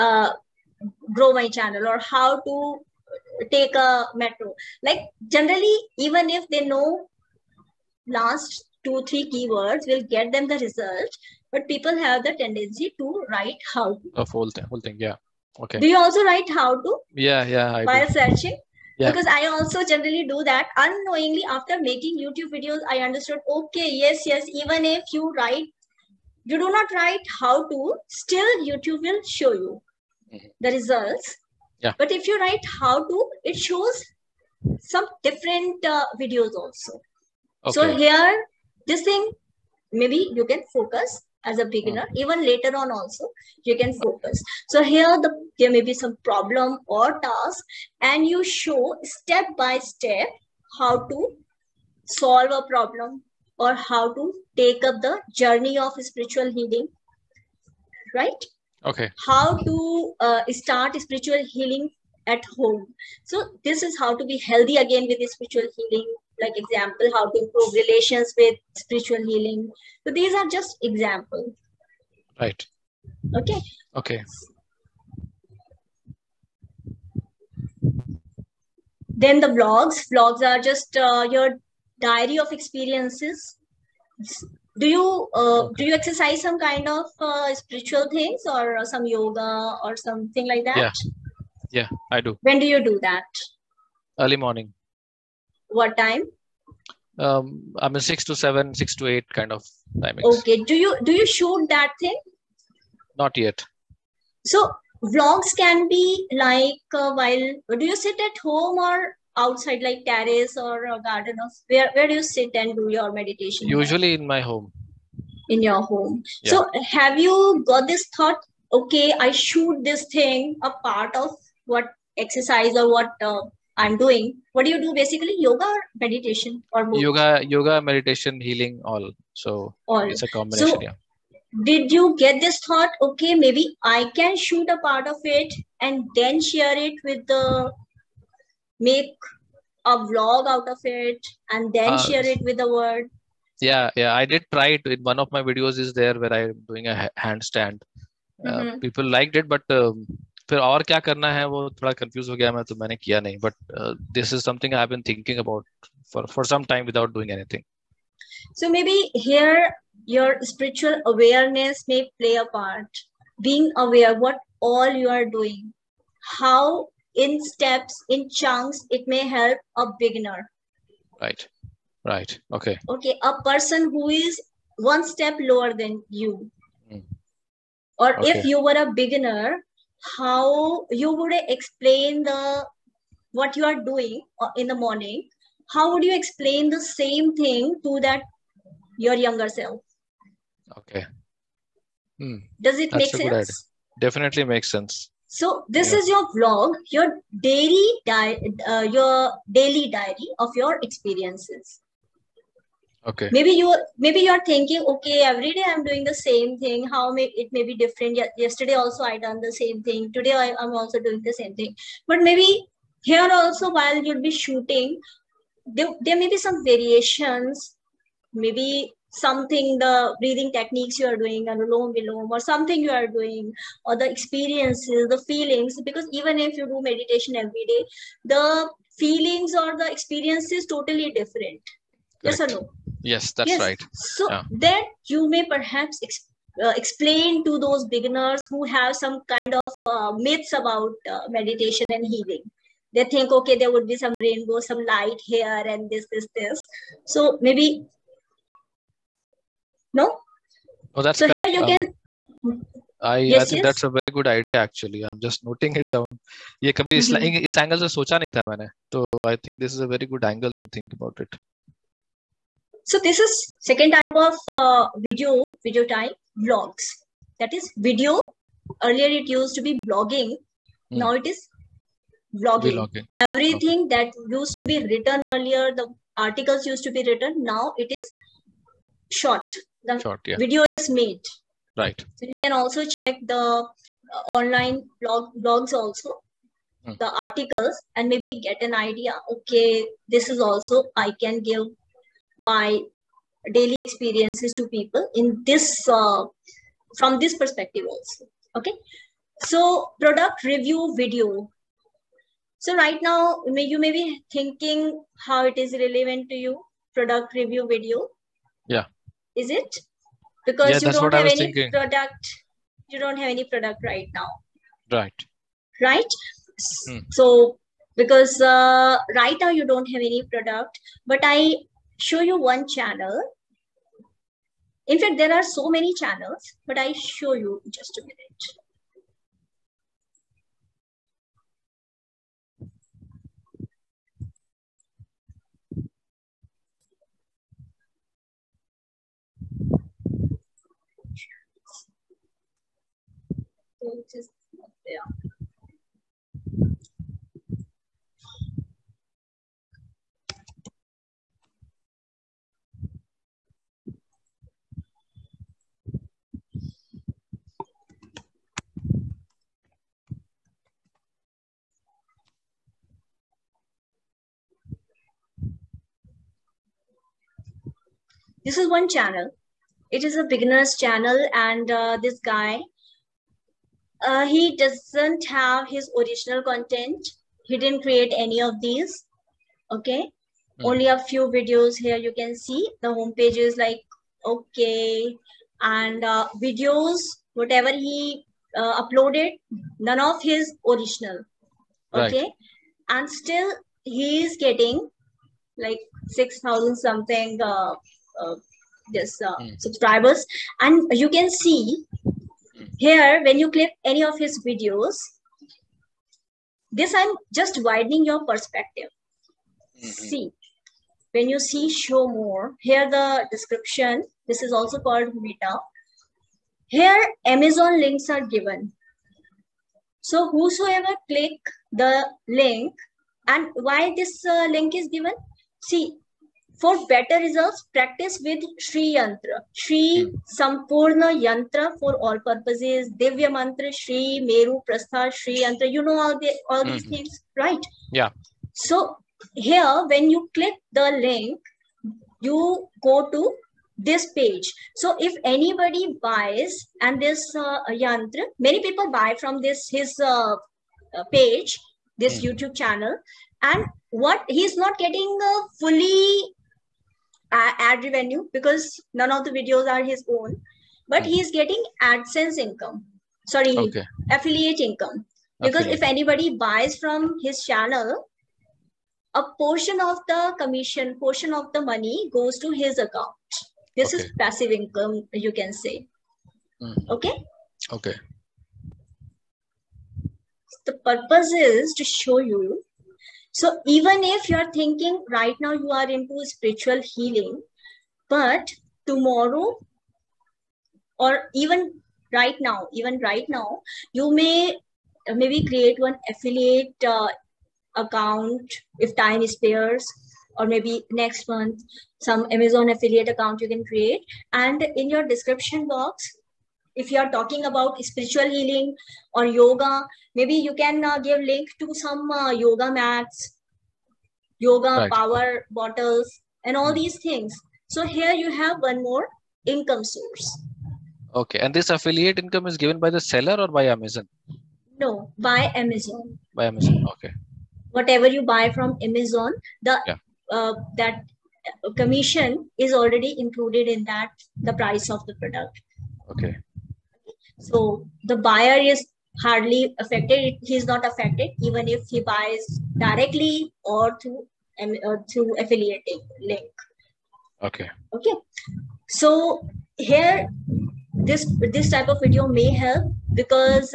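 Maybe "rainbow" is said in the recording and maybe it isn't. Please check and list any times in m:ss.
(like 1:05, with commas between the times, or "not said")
4:04.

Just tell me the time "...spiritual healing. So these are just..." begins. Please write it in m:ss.
1:08.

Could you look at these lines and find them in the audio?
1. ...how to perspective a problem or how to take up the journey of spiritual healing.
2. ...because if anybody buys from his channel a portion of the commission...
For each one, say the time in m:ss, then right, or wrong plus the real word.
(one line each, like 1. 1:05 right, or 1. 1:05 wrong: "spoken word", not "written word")
1. 0:50 wrong: "solve", not "perspective"
2. 7:45 right.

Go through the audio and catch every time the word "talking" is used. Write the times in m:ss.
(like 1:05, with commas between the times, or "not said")
8:27.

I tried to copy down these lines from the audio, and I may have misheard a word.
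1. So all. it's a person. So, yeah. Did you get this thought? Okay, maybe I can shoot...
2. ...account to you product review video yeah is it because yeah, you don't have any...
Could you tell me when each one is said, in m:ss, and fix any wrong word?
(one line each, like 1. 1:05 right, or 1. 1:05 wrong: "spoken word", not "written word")
1. 2:09 wrong: "combination", not "person"
2. 5:05 wrong: "relevant", not "account".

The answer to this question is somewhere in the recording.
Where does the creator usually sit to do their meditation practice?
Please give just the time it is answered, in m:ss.
1:53.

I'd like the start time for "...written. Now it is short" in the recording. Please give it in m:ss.
4:37.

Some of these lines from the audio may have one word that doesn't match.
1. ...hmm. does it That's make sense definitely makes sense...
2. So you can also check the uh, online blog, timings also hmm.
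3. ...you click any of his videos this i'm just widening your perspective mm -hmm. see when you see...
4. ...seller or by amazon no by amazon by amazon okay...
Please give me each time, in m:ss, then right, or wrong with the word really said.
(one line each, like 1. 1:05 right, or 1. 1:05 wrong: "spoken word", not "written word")
1. 3:12 right
2. 4:42 wrong: "blogs", not "timings"
3. 6:43 right
4. 8:43 right.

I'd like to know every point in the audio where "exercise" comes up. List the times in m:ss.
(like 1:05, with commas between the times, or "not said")
1:25, 2:02.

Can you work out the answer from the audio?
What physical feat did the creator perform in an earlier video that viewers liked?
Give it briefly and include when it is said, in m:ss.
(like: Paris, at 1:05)
A handstand, at 2:26.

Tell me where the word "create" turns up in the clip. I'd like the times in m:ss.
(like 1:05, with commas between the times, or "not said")
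6:17, 8:15, 8:23.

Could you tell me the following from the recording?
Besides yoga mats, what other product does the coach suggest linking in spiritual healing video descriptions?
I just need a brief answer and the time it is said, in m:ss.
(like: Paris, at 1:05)
Power bottles, at 8:34.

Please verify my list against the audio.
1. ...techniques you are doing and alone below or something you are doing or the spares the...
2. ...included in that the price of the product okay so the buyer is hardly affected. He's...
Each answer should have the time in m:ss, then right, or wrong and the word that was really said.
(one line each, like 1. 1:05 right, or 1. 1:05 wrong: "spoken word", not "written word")
1. 3:40 wrong: "experiences", not "spares"
2. 8:53 right.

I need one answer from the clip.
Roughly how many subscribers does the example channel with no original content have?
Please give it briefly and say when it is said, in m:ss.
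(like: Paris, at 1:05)
6,000, at 6:36.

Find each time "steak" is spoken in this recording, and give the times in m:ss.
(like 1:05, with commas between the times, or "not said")
not said.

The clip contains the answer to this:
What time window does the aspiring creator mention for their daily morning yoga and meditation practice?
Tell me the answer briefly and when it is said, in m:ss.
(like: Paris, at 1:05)
6 to 8, at 1:38.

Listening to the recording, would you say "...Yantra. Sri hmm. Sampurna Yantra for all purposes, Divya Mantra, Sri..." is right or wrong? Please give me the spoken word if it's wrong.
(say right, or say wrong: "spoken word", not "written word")
right.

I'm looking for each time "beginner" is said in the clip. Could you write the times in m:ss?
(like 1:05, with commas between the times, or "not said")
0:41, 2:50, 2:59, 3:57, 6:10.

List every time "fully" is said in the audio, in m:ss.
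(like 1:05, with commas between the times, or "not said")
7:35.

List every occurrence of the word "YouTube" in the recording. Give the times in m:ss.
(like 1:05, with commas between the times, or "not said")
0:22, 0:28, 7:32.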